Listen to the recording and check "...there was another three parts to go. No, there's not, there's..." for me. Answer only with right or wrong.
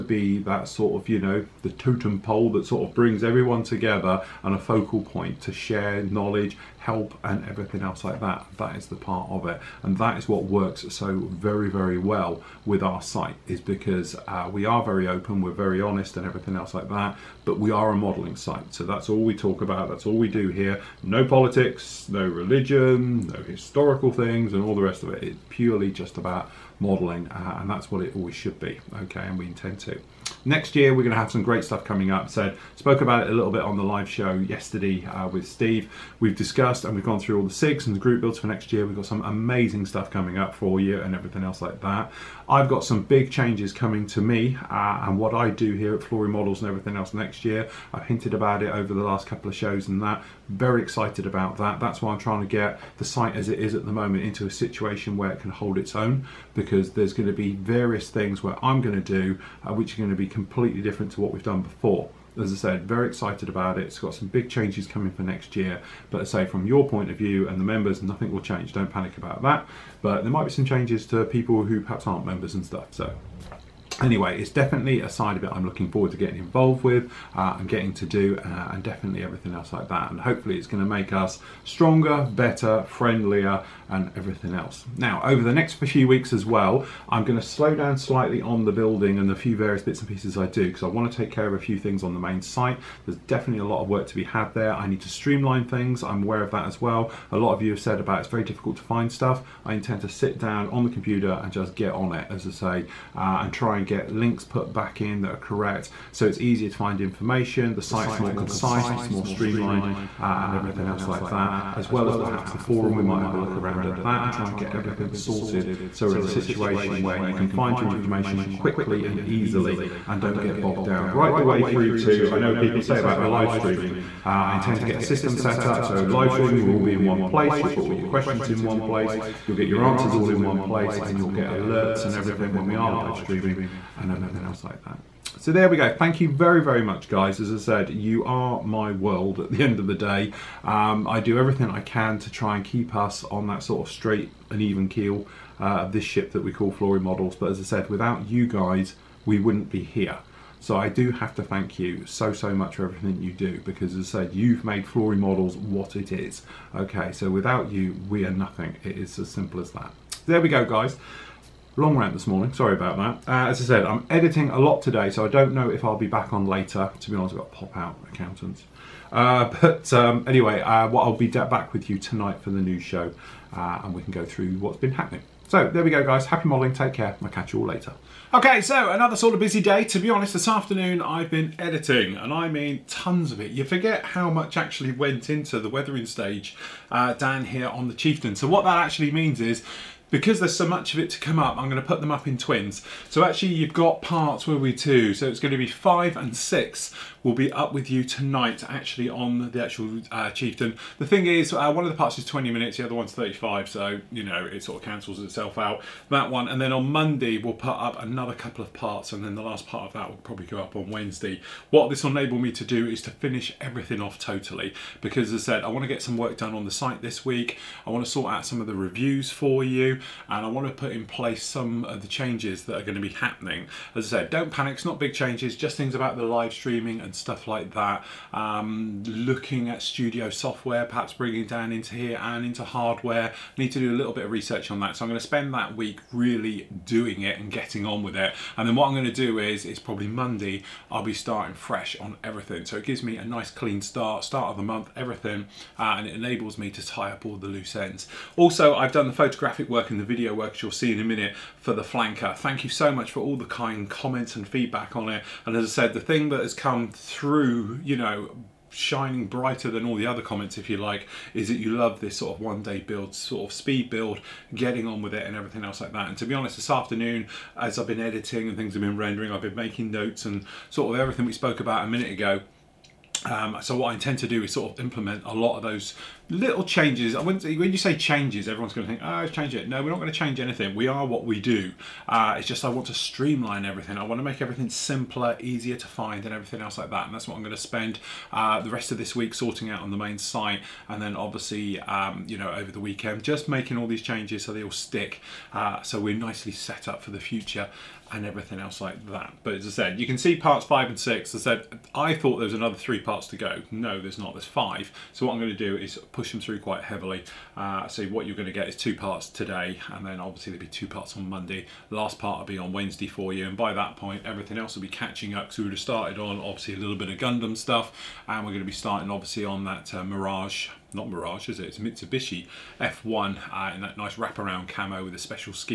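right.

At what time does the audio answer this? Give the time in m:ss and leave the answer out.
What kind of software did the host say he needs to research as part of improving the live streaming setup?
3:49.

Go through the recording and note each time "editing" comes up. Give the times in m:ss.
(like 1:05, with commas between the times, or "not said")
2:44, 3:01, 4:27.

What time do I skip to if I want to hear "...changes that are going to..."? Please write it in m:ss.
3:42.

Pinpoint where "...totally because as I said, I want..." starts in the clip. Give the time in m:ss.
3:34.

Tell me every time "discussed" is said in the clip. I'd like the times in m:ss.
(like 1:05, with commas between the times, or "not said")
0:36.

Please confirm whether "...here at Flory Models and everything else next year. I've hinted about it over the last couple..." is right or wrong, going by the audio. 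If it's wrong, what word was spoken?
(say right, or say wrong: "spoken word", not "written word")
right.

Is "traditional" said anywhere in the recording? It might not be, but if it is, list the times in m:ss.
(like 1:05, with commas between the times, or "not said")
not said.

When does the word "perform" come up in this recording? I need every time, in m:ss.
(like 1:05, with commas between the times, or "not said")
not said.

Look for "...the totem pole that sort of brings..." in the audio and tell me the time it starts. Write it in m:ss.
0:01.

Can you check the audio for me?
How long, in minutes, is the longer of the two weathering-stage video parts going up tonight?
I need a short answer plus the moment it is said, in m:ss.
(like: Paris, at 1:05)
35, at 3:23.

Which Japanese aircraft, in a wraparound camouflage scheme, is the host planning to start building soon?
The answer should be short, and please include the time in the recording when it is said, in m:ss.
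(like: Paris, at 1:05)
Mitsubishi F1, at 5:21.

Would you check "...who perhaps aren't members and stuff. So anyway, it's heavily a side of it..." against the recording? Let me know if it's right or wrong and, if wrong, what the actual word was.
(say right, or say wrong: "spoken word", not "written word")
wrong: "definitely", not "heavily".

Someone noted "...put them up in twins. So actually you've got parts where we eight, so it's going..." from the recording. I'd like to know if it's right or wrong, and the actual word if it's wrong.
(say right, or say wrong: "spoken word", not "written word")
wrong: "two", not "eight".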